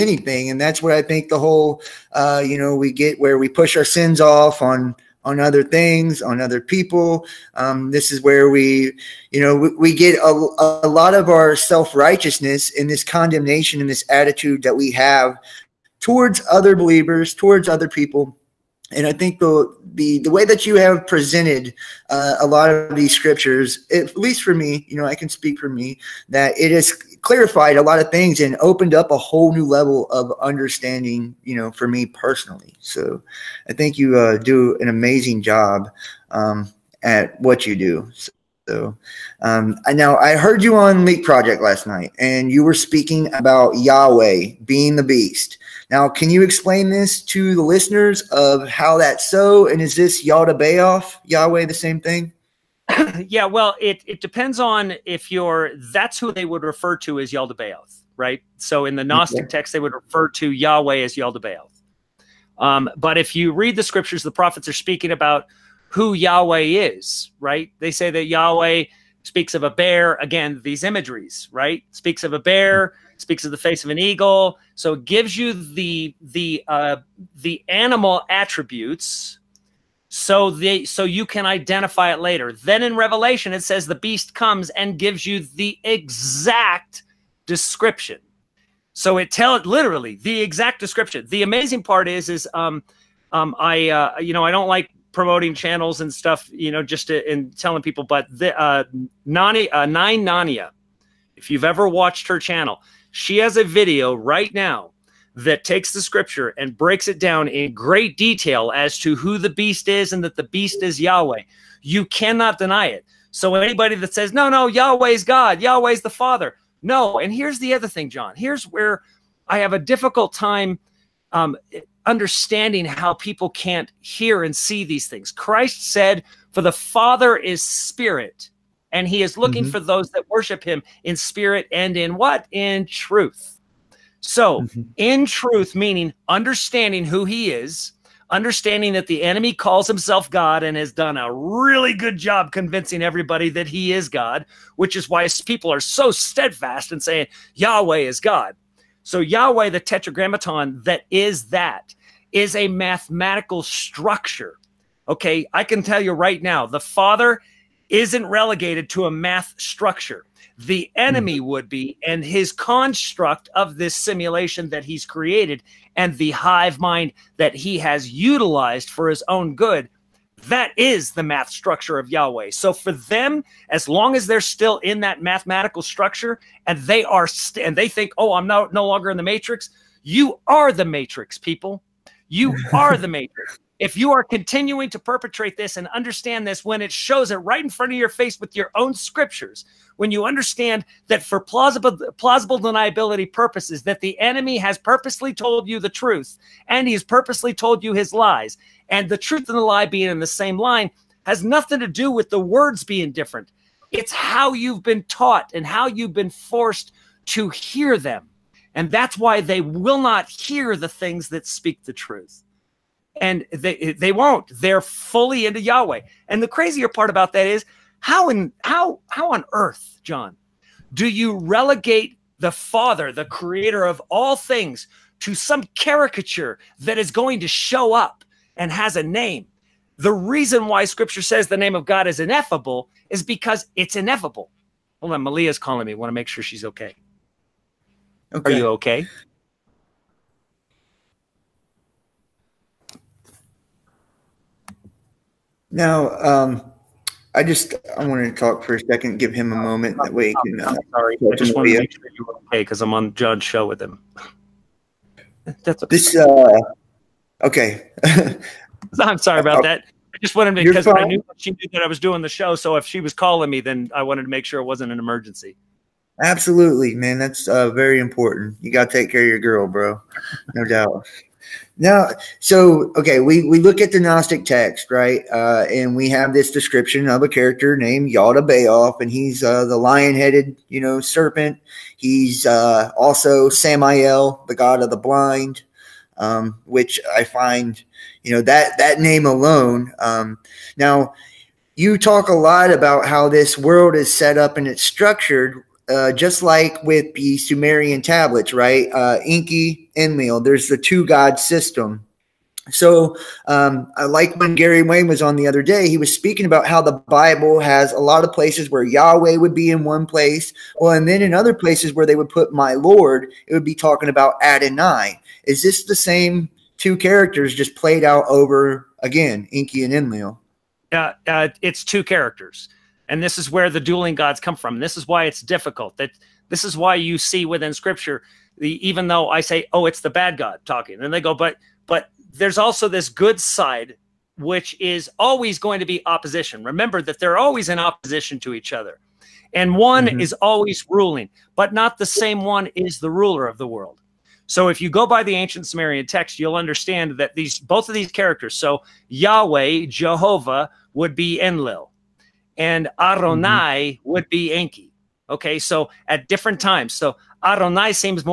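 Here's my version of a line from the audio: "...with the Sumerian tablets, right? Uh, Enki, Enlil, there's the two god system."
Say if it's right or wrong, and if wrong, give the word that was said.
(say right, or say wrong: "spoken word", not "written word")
right.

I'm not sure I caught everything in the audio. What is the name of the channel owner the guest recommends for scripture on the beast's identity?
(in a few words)
Nine Nania.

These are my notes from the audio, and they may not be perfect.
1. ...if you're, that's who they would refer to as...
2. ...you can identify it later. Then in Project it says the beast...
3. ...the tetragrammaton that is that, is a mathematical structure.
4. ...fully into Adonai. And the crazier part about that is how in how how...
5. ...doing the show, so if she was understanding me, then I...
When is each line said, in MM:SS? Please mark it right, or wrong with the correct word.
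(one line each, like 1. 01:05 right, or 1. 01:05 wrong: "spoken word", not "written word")
1. 00:55 right
2. 01:21 wrong: "Revelation", not "Project"
3. 02:29 right
4. 03:34 wrong: "Yahweh", not "Adonai"
5. 04:21 wrong: "calling", not "understanding".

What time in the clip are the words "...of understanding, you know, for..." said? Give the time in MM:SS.
00:30.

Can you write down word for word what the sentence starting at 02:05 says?
Christ said, For the Father is spirit, and he is looking mm-hmm.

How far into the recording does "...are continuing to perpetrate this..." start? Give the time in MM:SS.
03:04.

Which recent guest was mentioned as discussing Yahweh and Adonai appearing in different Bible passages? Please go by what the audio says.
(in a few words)
Gary Wayne.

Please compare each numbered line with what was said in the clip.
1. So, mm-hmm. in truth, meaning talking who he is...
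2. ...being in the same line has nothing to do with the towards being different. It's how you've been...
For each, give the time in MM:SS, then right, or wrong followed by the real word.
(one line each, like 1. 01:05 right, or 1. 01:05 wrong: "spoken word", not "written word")
1. 02:14 wrong: "understanding", not "talking"
2. 03:19 wrong: "words", not "towards".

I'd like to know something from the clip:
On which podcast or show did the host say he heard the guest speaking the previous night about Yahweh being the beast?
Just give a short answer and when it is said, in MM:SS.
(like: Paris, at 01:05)
Leak Project, at 00:41.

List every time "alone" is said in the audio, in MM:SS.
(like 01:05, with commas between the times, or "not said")
04:49.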